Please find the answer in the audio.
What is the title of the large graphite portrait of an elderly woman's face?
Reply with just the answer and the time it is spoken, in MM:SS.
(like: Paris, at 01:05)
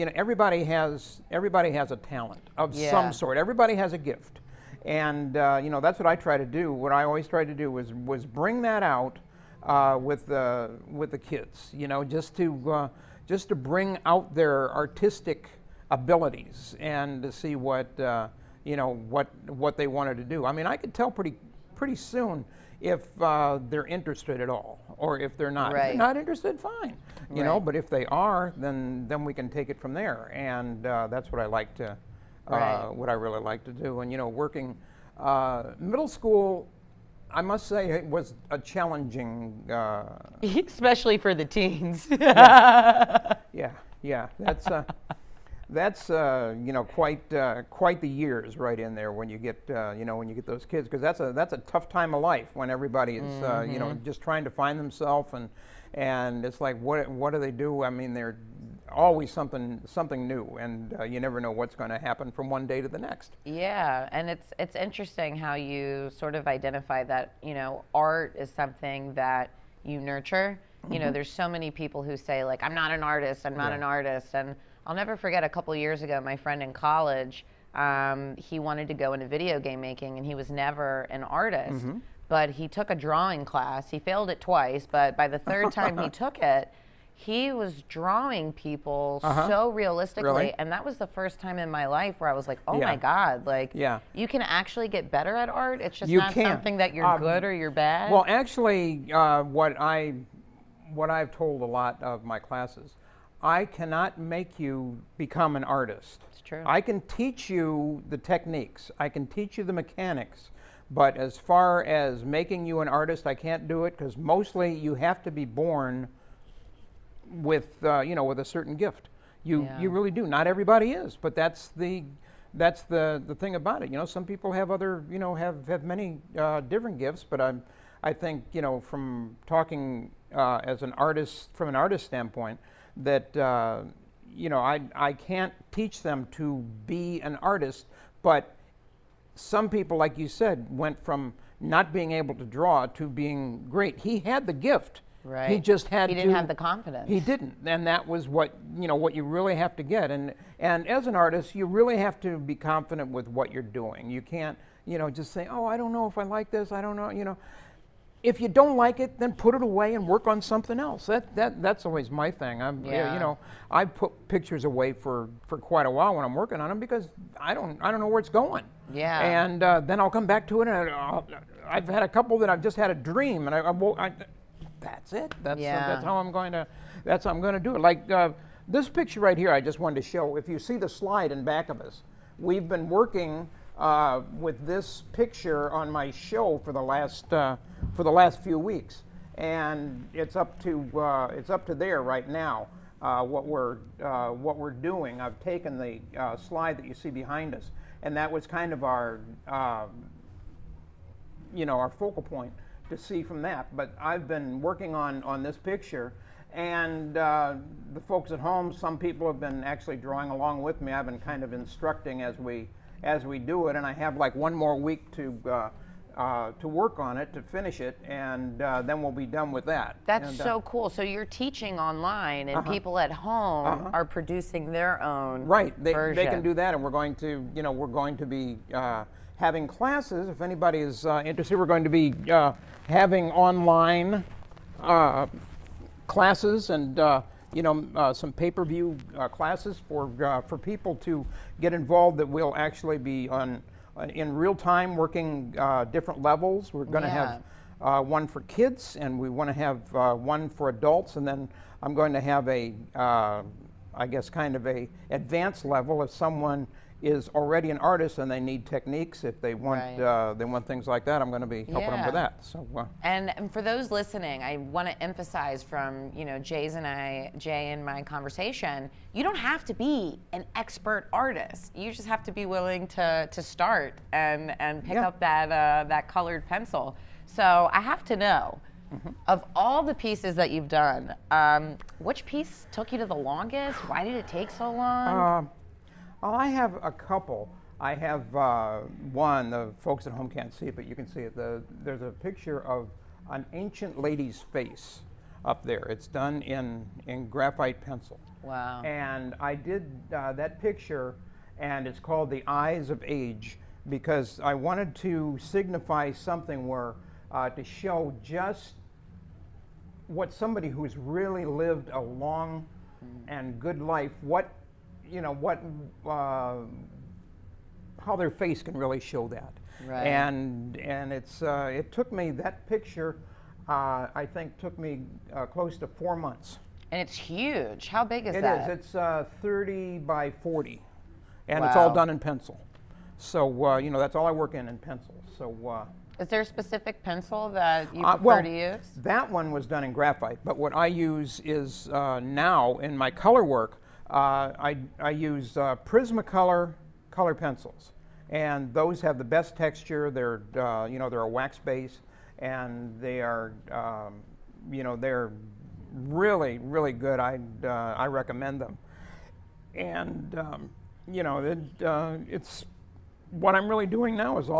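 The Eyes of Age, at 05:02.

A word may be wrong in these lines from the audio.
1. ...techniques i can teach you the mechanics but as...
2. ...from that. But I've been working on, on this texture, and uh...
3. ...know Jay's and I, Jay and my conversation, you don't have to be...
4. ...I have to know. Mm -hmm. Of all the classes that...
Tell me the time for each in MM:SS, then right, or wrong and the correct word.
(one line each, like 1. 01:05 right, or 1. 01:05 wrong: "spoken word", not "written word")
1. 01:48 right
2. 03:23 wrong: "picture", not "texture"
3. 04:26 right
4. 04:37 wrong: "pieces", not "classes".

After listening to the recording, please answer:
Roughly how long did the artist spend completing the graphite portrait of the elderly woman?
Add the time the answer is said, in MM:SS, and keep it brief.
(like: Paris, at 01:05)
close to 4 months, at 05:25.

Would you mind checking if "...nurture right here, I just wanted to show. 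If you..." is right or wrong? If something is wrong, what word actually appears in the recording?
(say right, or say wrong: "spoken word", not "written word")
wrong: "picture", not "nurture".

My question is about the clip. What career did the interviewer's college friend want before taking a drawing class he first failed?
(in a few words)
video game making.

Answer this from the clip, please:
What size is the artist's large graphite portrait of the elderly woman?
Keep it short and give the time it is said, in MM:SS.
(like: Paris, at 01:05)
30 by 40, at 05:29.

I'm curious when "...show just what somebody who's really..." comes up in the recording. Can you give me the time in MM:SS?
05:07.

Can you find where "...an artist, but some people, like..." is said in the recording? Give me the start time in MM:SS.
02:17.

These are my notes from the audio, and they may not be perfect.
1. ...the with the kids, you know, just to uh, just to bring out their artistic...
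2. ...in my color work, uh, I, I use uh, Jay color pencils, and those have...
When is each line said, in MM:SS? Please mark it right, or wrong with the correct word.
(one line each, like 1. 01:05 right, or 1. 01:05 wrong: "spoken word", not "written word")
1. 00:10 right
2. 05:42 wrong: "Prismacolor", not "Jay".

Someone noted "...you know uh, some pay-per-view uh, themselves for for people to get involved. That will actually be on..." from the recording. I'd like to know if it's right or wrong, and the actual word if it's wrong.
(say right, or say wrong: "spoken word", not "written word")
wrong: "classes", not "themselves".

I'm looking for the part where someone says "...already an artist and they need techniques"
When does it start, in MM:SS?
04:17.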